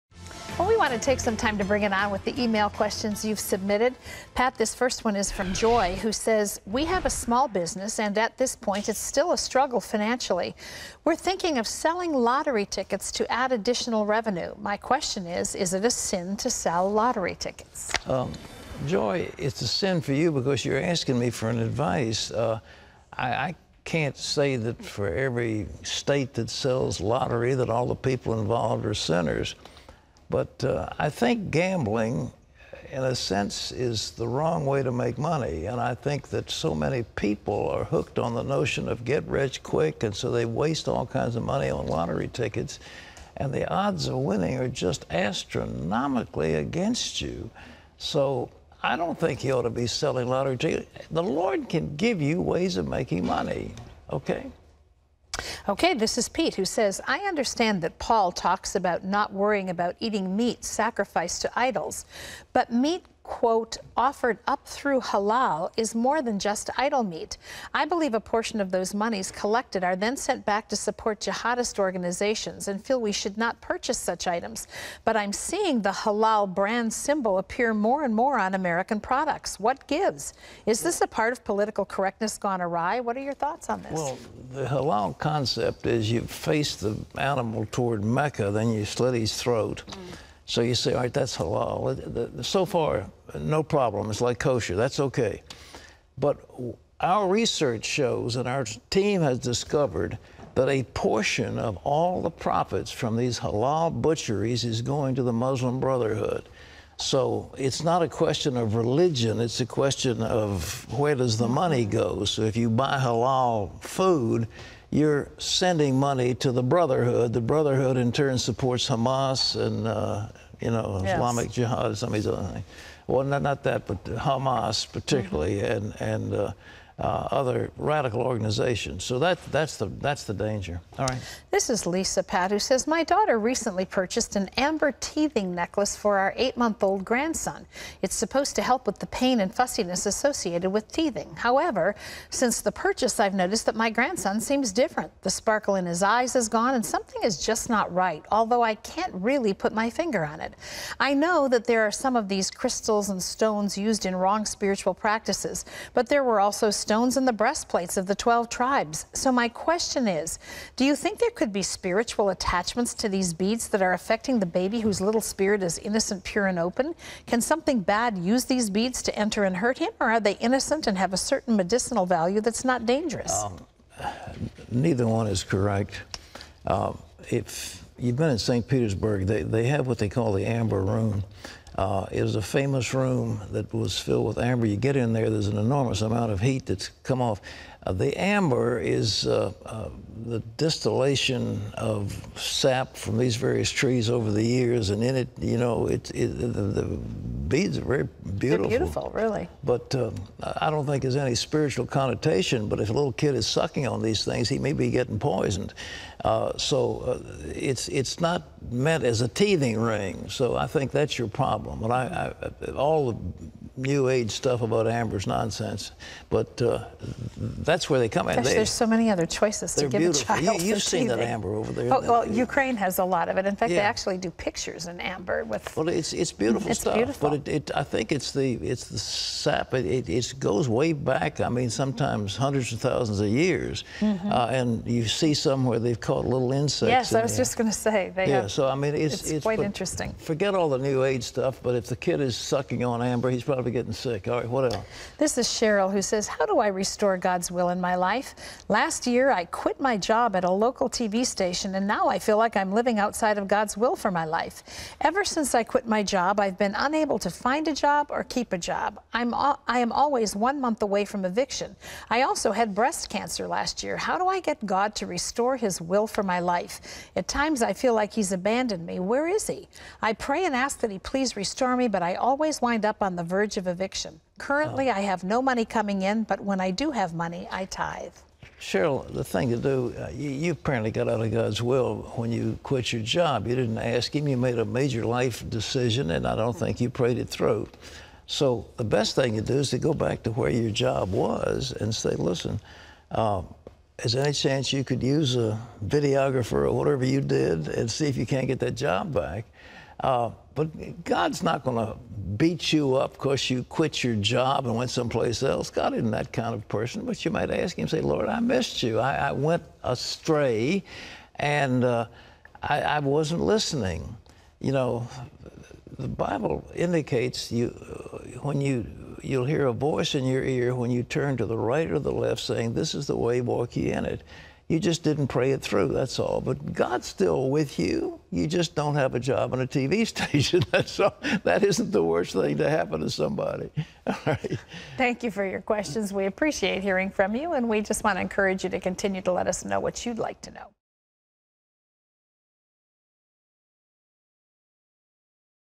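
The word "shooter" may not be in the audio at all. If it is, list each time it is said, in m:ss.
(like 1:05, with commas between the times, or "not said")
not said.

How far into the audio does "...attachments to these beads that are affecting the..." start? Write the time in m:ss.
2:42.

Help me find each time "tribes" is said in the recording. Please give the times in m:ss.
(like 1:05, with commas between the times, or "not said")
2:38.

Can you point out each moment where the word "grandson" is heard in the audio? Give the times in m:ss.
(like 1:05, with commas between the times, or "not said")
2:17, 2:23.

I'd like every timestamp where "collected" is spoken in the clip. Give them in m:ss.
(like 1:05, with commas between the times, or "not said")
1:09.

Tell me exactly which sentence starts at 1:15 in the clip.
But I'm seeing the halal brand symbol appear more and more on American products.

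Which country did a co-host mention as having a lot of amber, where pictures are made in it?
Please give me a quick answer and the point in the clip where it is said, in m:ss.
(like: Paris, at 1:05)
Ukraine, at 3:42.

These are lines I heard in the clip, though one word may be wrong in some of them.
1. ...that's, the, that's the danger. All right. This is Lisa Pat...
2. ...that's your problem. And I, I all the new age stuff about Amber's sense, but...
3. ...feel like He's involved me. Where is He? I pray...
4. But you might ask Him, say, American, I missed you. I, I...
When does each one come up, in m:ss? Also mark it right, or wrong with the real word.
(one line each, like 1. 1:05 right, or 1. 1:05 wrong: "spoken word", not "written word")
1. 2:09 right
2. 3:30 wrong: "nonsense", not "sense"
3. 4:27 wrong: "abandoned", not "involved"
4. 5:07 wrong: "Lord", not "American".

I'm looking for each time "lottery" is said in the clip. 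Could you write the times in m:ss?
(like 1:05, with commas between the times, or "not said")
0:12, 0:16, 0:26, 0:41, 0:50.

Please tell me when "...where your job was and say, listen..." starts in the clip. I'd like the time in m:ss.
4:50.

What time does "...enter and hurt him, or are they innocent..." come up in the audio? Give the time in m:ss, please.
2:49.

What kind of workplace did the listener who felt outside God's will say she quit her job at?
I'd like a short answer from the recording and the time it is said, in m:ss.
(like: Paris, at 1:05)
local TV station, at 4:10.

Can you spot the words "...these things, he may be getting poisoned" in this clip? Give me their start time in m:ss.
3:24.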